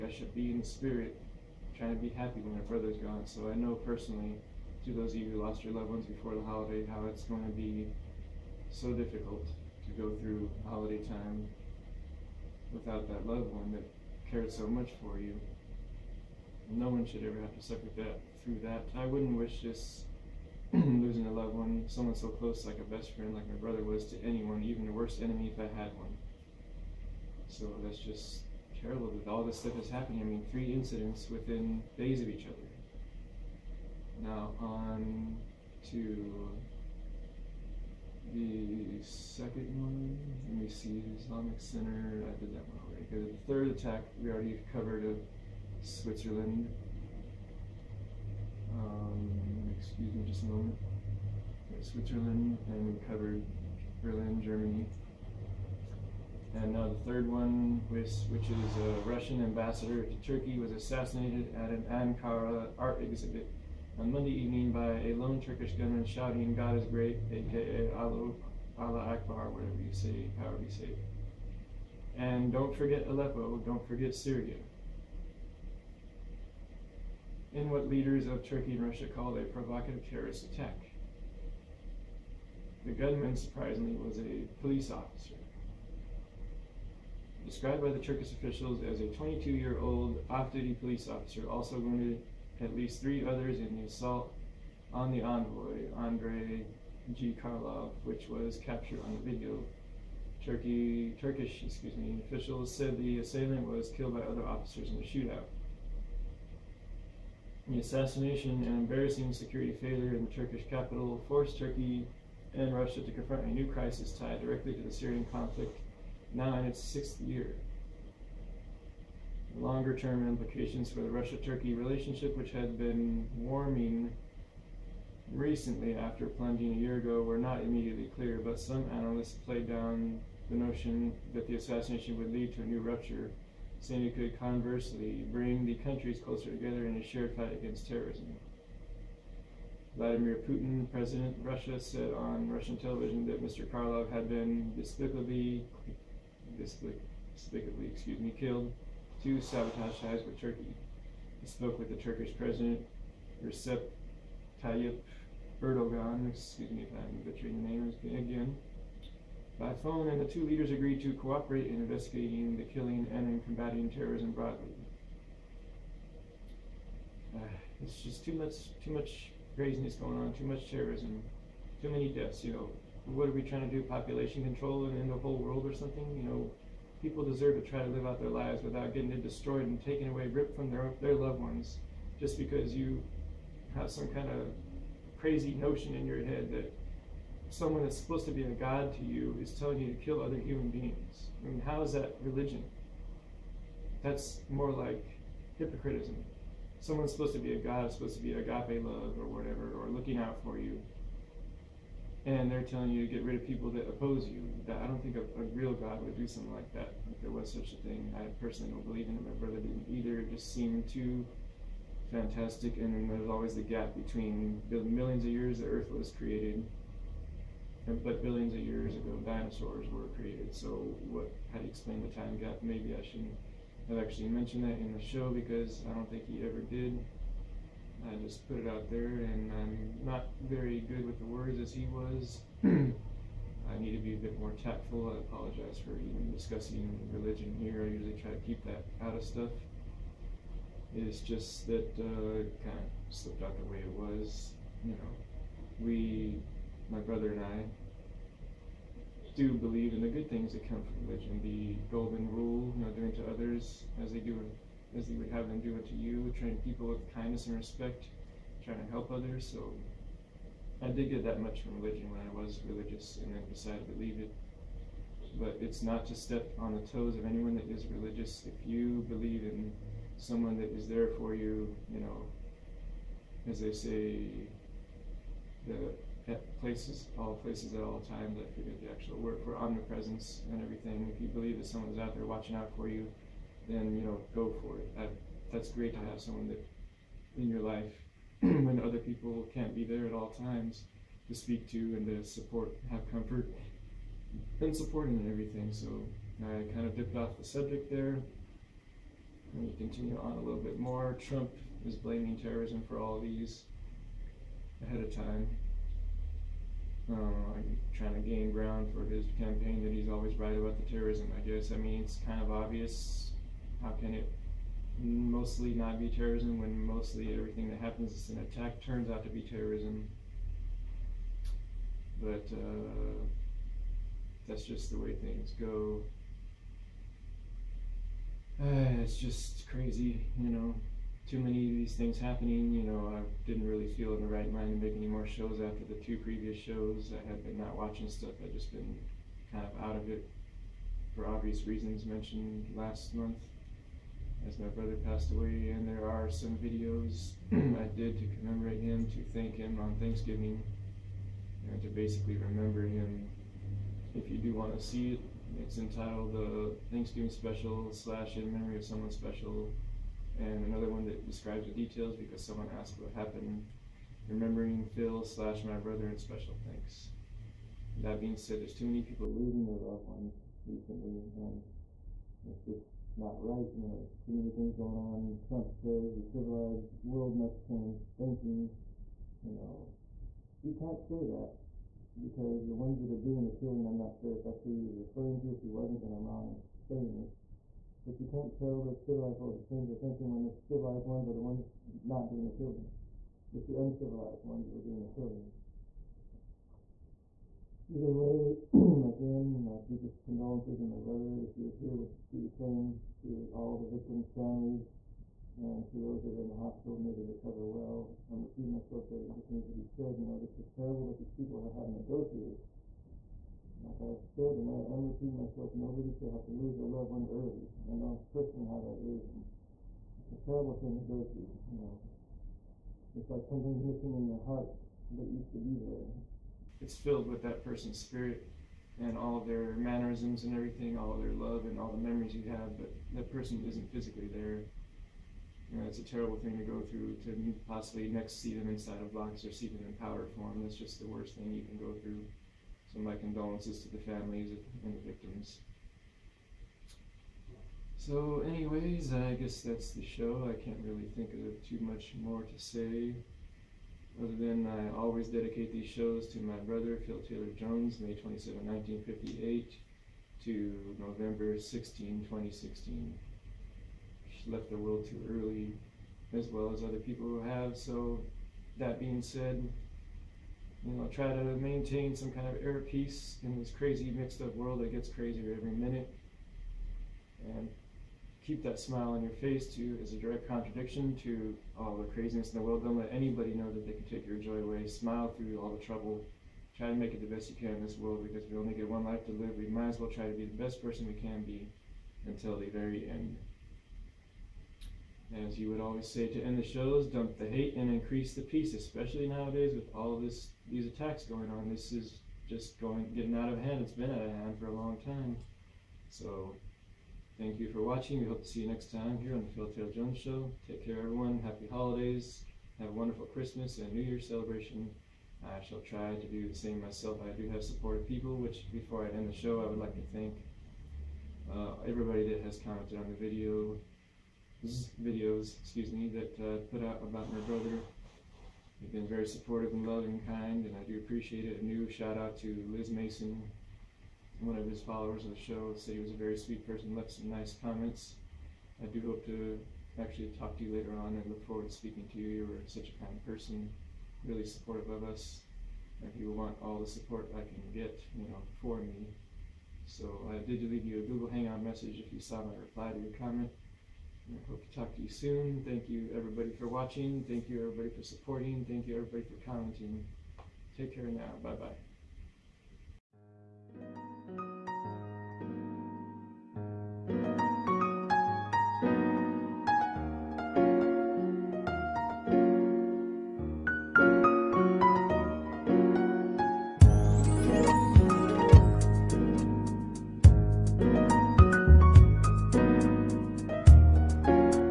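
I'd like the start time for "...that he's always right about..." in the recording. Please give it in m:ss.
5:09.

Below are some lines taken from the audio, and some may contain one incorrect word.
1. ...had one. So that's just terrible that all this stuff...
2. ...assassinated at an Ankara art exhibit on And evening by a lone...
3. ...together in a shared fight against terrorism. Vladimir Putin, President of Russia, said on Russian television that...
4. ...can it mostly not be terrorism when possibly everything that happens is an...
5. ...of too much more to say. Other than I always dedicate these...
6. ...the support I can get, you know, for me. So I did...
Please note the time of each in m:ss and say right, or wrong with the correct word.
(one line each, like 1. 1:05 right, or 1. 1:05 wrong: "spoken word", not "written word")
1. 0:25 right
2. 1:00 wrong: "Monday", not "And"
3. 2:16 right
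4. 5:13 wrong: "mostly", not "possibly"
5. 7:31 right
6. 9:06 right.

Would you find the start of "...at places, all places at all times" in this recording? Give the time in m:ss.
4:36.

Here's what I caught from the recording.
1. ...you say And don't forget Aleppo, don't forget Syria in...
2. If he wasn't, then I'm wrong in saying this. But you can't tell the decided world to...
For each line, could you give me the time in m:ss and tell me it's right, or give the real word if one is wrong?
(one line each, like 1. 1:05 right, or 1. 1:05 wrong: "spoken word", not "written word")
1. 1:10 right
2. 6:25 wrong: "civilized", not "decided".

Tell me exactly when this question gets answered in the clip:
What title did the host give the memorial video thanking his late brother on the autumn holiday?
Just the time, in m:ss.
5:56.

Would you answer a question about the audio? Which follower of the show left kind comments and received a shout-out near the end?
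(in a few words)
Liz Mason.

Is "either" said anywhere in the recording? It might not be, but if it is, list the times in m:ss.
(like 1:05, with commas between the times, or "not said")
3:29, 6:37.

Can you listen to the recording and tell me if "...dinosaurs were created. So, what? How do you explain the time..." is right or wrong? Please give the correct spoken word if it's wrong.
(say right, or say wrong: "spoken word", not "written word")
right.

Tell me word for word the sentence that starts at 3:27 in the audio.
If there was such a thing, I personally don't believe in it.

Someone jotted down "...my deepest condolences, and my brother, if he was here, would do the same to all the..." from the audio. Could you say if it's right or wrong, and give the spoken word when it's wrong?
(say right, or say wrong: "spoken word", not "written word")
right.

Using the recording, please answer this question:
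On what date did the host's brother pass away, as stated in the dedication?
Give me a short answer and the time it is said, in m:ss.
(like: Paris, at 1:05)
November 16, 2016, at 7:40.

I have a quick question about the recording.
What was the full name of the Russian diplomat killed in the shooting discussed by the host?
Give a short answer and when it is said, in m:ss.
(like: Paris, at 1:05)
Andrei G. Karlov, at 1:35.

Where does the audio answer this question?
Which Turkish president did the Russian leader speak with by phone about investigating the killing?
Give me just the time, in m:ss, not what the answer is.
2:33.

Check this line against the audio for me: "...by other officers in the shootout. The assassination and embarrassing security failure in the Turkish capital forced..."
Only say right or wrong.
right.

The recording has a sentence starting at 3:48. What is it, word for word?
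I just put it out there, and I'm not very good with the words as he was.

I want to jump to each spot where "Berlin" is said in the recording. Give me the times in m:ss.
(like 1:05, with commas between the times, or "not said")
0:54.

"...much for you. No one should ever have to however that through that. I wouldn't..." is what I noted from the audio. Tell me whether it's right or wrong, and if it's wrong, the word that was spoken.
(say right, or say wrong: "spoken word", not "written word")
wrong: "suffer", not "however".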